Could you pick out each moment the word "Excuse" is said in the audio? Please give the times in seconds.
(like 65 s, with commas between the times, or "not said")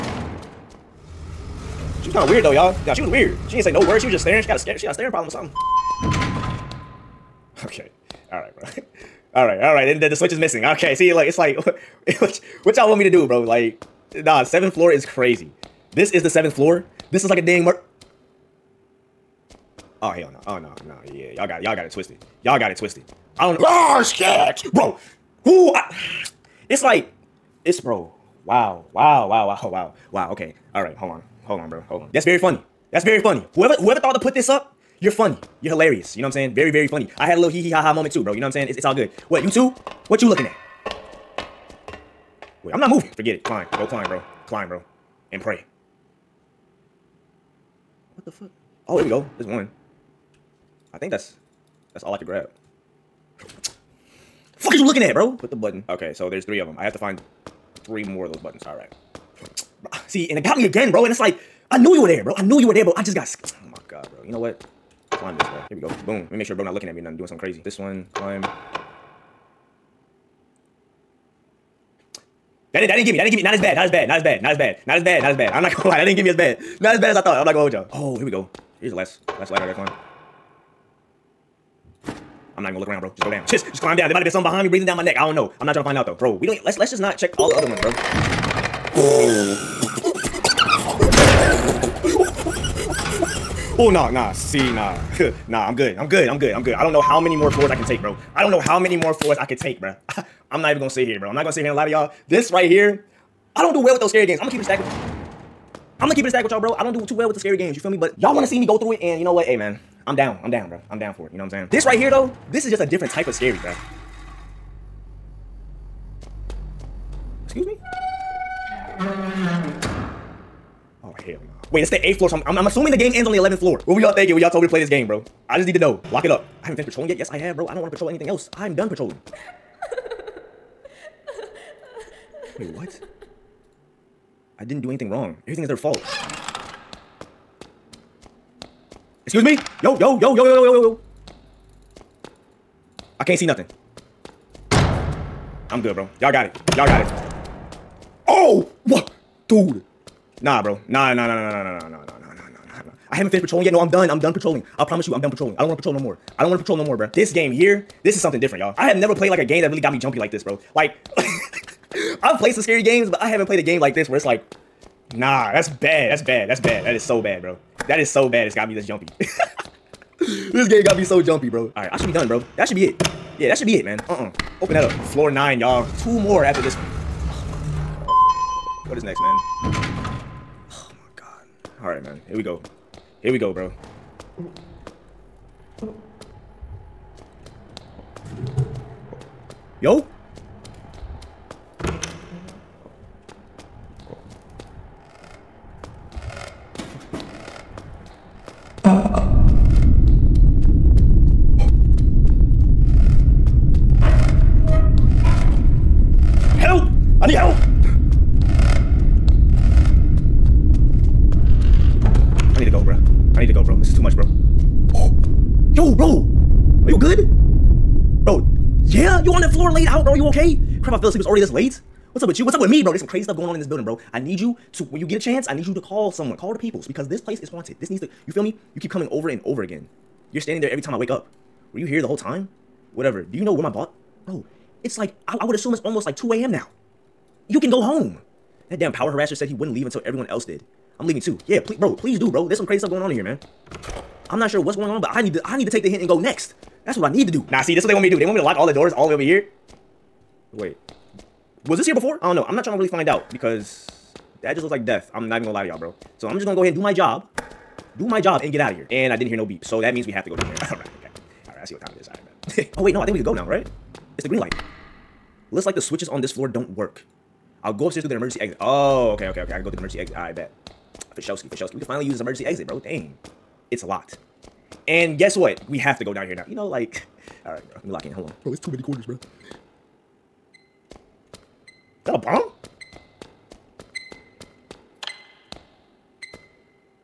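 117 s, 139 s.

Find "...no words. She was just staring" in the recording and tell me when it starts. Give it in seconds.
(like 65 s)
3 s.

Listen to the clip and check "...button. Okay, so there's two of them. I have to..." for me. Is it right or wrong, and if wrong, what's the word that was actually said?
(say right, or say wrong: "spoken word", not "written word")
wrong: "three", not "two".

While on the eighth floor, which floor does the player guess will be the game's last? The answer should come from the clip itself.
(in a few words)
11th floor.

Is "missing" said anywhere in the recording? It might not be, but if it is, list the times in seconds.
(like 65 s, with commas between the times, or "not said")
10 s.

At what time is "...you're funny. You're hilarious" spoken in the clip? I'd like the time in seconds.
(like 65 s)
35 s.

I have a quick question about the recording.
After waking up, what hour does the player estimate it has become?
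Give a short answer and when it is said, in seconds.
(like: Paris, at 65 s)
2 a.m., at 235 s.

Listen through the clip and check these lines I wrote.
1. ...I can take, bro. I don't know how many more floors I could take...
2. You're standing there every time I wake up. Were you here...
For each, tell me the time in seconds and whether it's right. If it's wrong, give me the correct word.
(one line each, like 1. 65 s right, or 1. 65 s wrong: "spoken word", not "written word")
1. 97 s right
2. 230 s right.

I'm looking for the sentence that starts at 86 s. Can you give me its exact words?
Bro, we don't let's let's just not check all the other ones, bro.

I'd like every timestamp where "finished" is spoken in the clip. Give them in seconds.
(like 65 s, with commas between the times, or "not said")
126 s, 153 s.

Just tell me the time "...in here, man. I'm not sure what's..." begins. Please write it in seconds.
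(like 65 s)
243 s.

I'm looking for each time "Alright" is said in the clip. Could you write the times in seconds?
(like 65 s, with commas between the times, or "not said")
181 s.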